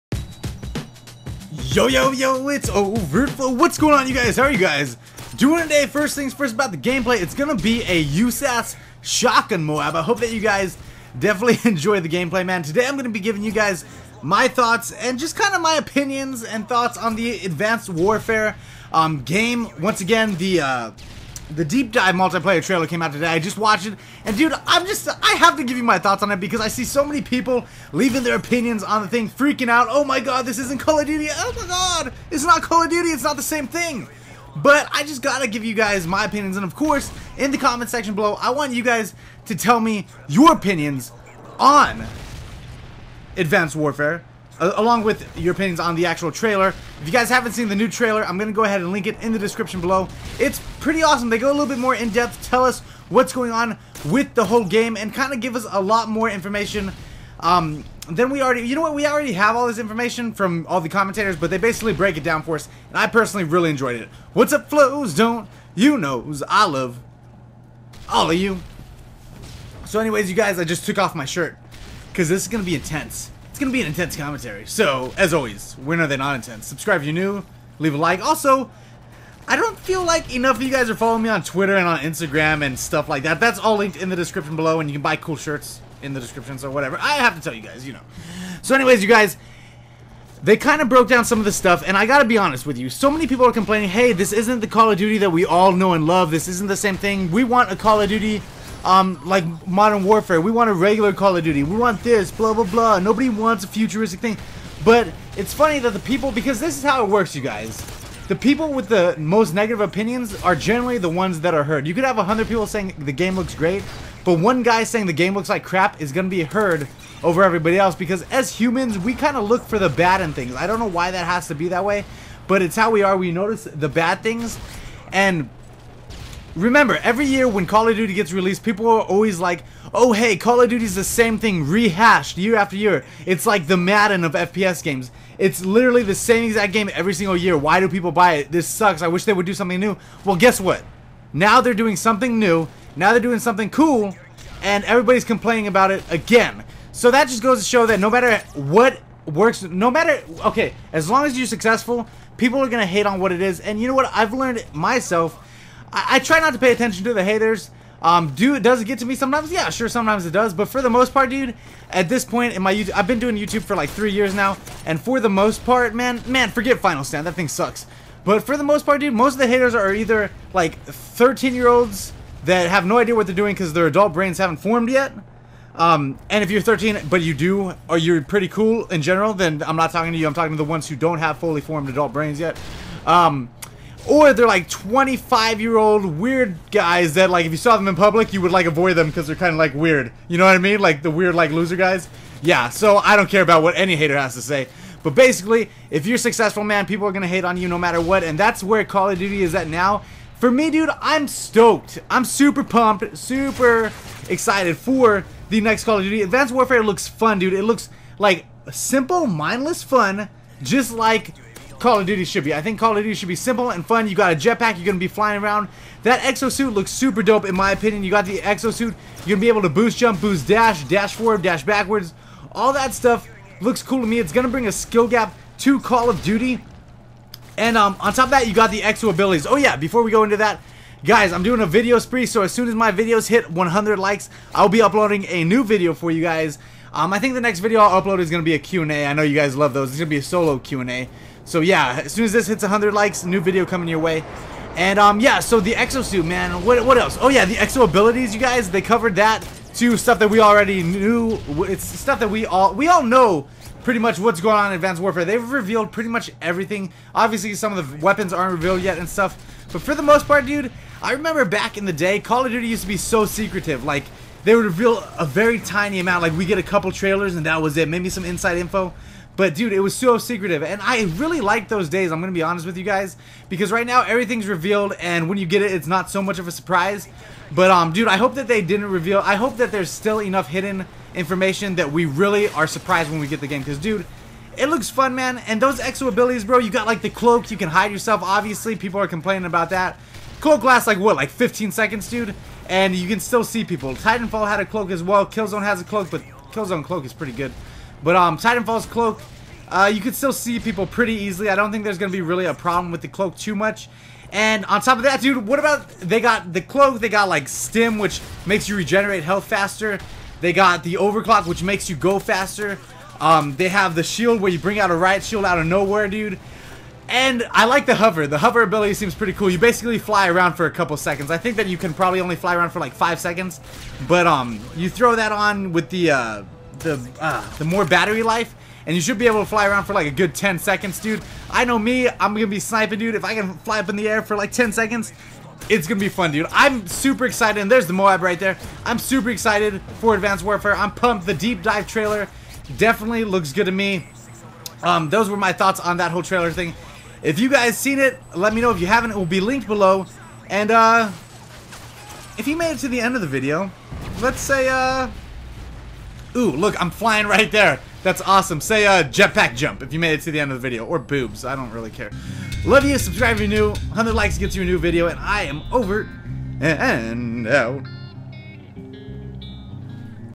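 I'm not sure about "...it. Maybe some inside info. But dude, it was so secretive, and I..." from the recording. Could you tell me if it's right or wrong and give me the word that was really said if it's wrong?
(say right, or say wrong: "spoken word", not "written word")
right.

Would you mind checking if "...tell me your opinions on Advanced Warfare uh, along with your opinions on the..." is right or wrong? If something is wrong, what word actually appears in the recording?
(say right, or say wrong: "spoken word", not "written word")
right.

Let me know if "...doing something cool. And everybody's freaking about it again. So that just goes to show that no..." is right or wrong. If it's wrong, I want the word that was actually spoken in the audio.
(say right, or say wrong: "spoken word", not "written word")
wrong: "complaining", not "freaking".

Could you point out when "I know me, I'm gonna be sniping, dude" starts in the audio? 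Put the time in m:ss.
5:31.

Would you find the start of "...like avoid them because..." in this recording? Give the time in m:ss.
3:08.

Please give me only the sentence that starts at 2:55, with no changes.
Um, and if you're 13, but you do, or you're pretty cool in general, then I'm not talking to you.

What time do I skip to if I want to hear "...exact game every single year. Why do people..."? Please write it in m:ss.
2:16.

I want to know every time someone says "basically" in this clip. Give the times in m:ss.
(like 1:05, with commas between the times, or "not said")
1:01, 3:15, 5:19.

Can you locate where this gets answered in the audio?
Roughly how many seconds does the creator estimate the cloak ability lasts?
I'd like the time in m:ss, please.
4:51.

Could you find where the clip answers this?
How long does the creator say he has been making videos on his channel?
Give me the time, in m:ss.
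2:43.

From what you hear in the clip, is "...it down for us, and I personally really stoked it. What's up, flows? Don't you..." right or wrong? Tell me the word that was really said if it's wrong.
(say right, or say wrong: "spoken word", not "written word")
wrong: "enjoyed", not "stoked".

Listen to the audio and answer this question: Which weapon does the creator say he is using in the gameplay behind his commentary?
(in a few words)
USAS shotgun.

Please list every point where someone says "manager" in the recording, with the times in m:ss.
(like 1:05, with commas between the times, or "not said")
not said.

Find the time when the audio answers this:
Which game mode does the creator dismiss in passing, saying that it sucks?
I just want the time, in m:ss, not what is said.
2:46.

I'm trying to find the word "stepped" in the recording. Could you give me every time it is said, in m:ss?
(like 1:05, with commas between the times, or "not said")
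not said.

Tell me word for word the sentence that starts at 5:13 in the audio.
Um, they have the shield where you bring out a riot shield out of nowhere, dude.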